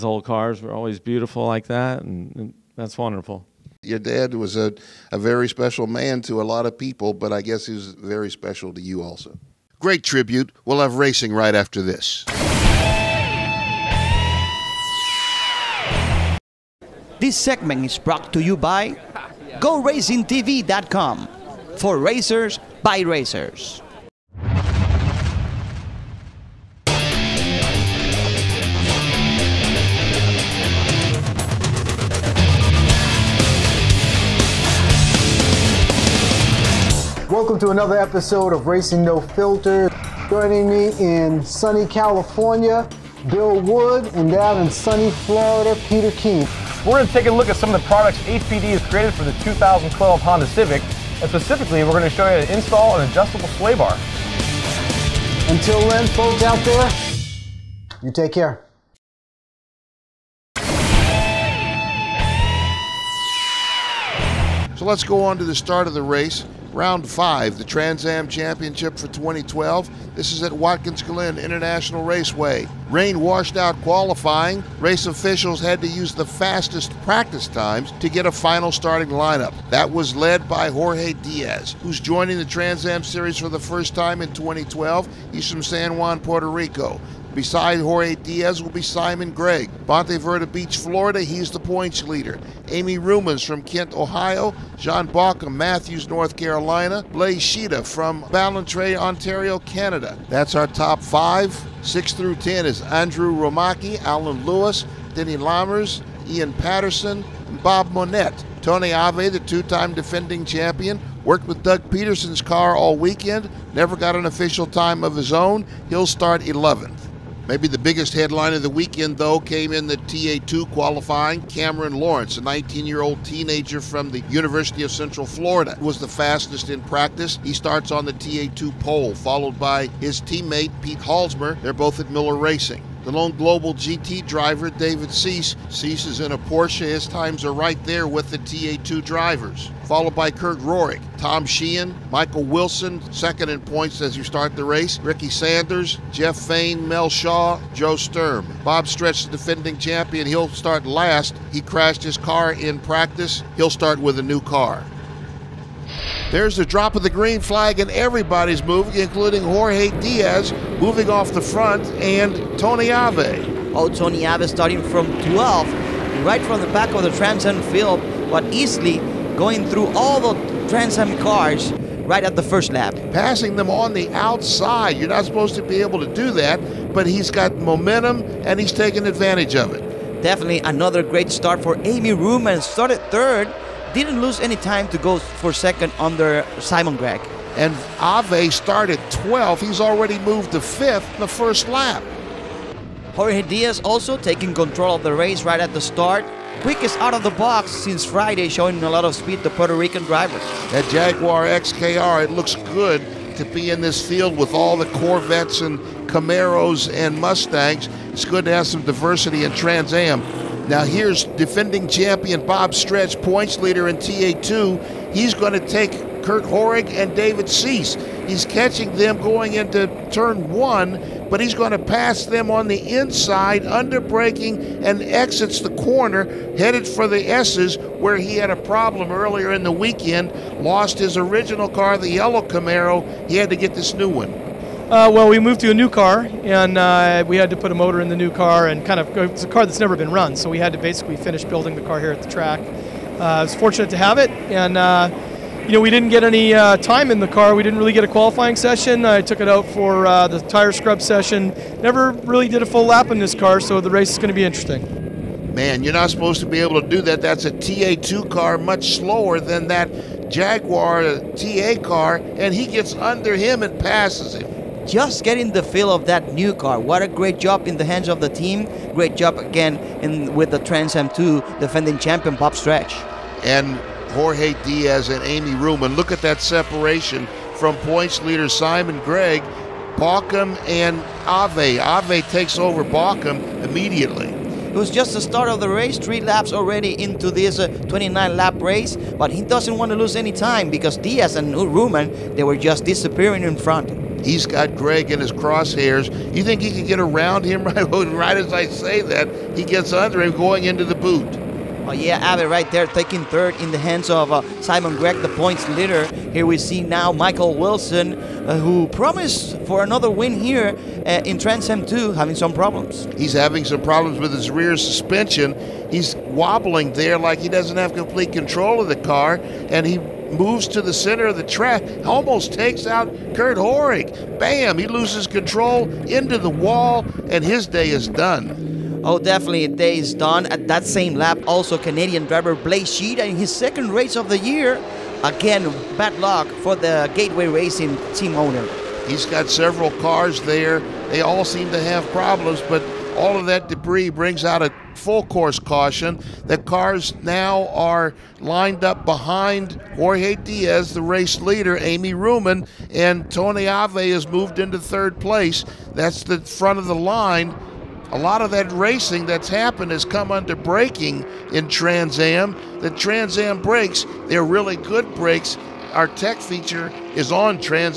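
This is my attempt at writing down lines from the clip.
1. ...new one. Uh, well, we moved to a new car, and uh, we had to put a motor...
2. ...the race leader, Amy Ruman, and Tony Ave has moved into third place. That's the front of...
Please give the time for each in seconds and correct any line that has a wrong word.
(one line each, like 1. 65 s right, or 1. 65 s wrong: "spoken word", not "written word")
1. 233 s right
2. 350 s right.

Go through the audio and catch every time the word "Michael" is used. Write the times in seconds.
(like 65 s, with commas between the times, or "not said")
142 s, 307 s.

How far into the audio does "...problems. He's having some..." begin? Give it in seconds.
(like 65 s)
312 s.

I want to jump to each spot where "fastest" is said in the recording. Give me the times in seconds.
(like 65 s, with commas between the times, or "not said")
76 s, 126 s.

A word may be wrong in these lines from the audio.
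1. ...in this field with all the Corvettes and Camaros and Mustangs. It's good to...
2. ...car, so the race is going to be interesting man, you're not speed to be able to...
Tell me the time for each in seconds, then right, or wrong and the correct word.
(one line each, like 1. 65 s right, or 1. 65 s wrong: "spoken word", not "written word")
1. 203 s right
2. 253 s wrong: "supposed", not "speed".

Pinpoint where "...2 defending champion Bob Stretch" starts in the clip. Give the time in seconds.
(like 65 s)
271 s.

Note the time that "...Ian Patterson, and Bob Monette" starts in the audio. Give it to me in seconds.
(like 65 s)
106 s.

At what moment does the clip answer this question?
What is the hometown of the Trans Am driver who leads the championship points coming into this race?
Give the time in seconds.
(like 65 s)
89 s.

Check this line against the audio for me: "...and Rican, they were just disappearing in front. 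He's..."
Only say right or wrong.
wrong.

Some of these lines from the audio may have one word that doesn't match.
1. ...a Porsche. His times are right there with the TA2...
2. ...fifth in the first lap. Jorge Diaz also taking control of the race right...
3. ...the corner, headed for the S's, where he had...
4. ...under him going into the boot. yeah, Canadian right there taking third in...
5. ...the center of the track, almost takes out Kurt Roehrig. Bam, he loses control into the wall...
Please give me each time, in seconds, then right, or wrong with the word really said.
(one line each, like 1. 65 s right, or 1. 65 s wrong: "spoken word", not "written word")
1. 136 s right
2. 190 s right
3. 225 s right
4. 299 s wrong: "Ave", not "Canadian"
5. 320 s right.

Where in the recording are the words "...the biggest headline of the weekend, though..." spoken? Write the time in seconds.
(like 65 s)
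117 s.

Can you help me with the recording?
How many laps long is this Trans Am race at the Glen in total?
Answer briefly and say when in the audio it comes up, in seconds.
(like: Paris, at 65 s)
29, at 287 s.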